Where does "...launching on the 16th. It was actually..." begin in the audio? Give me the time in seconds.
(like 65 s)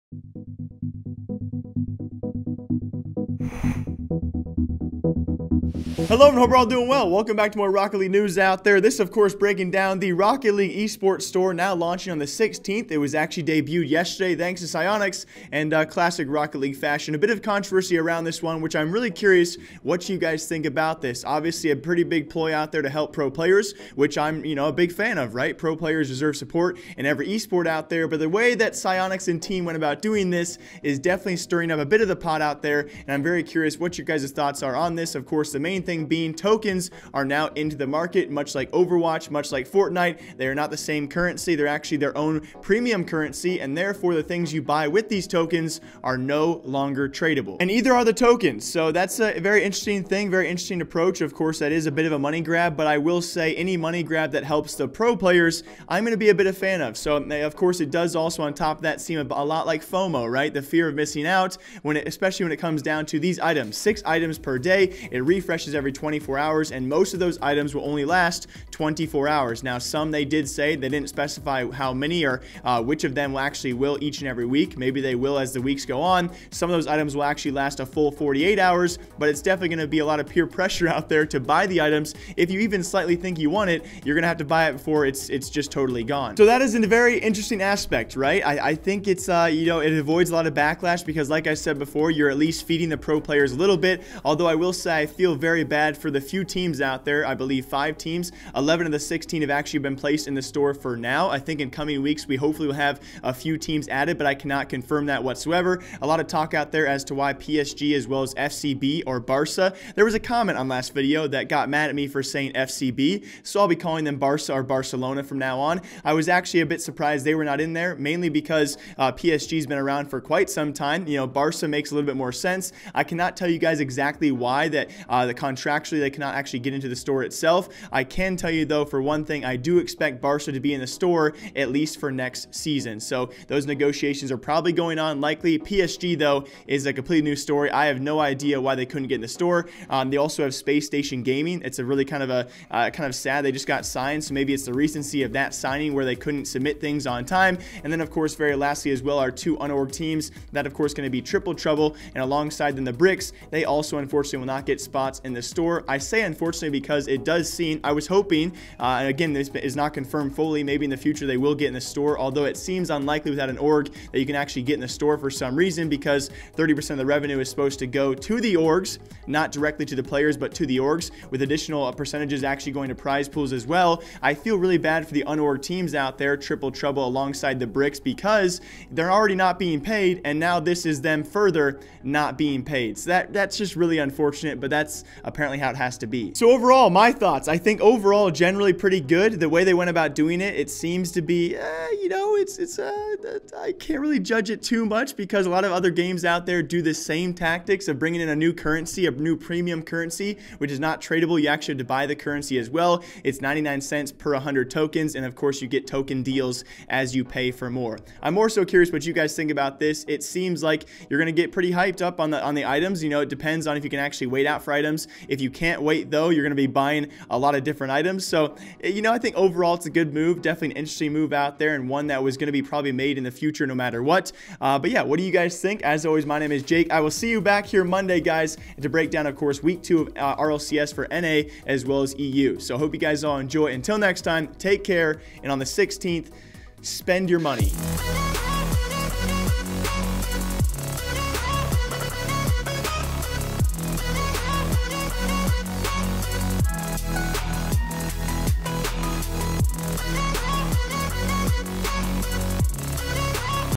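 11 s.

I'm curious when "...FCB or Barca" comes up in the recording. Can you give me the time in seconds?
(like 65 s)
108 s.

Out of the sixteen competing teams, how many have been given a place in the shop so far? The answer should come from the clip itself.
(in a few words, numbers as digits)
11.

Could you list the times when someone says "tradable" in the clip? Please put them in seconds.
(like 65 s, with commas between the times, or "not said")
47 s, 201 s.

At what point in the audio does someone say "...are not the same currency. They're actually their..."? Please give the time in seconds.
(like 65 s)
40 s.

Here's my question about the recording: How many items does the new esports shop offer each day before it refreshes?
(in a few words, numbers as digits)
6.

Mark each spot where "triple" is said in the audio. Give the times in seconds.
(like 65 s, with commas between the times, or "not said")
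151 s, 176 s.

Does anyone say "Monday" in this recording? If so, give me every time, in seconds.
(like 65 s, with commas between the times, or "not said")
227 s.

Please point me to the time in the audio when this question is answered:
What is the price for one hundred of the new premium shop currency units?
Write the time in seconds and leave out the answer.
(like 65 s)
203 s.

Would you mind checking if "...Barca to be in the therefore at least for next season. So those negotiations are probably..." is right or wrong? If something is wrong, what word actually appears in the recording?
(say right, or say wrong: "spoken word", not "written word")
wrong: "store", not "therefore".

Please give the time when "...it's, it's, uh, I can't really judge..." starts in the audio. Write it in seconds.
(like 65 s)
192 s.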